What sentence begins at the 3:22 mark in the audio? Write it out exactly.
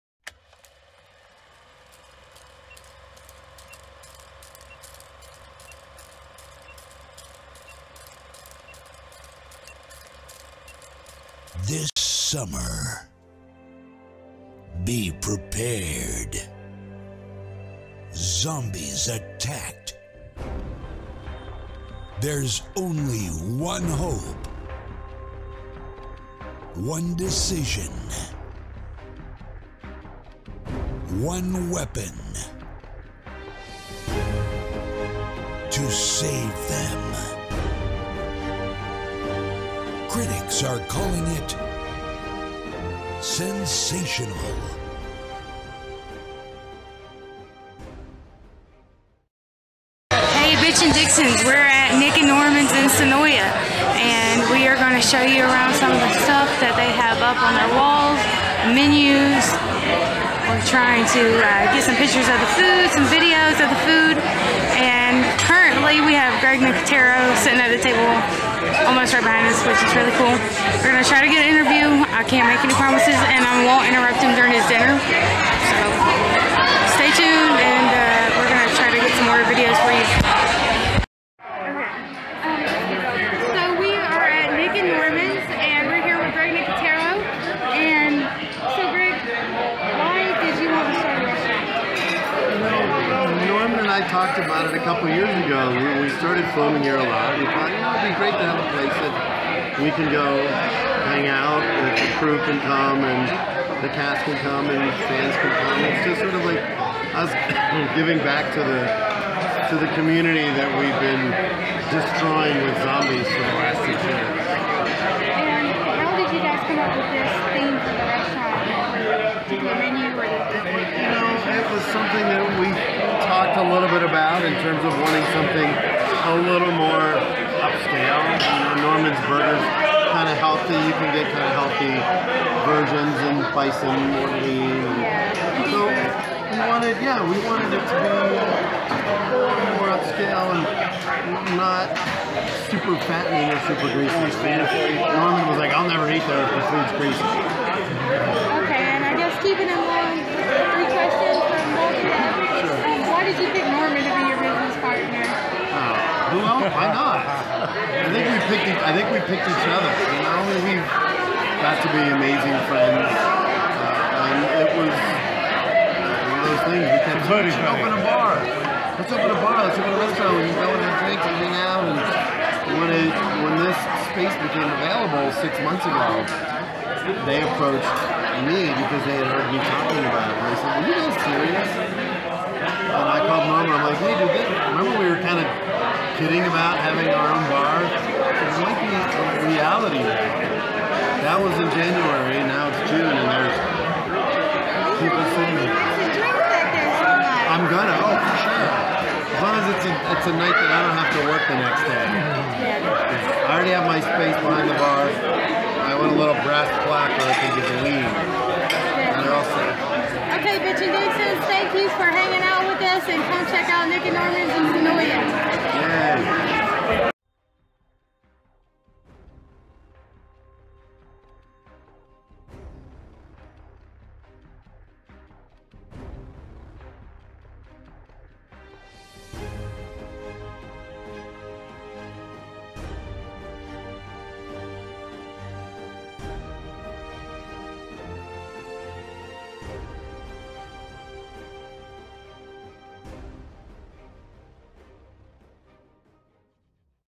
I already have my space behind the bar.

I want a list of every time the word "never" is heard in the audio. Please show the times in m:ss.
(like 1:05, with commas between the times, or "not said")
2:25.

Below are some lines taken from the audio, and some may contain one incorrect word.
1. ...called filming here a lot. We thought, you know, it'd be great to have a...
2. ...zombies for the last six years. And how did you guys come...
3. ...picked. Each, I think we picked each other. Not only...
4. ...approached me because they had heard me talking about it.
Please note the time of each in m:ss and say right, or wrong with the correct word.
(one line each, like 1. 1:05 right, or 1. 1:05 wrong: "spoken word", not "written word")
1. 1:36 wrong: "started", not "called"
2. 1:52 right
3. 2:38 right
4. 2:57 right.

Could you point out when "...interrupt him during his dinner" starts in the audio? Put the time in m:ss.
1:13.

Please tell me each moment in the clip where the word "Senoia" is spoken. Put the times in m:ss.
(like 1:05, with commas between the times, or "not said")
0:52.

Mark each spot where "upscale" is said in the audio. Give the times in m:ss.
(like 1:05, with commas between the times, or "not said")
2:07, 2:19.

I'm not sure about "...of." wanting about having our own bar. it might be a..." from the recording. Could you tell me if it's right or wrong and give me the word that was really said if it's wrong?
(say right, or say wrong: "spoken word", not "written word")
wrong: "kidding", not "wanting".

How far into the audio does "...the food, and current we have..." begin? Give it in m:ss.
1:03.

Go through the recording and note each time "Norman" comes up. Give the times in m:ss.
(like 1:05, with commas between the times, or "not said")
0:52, 2:08, 2:24.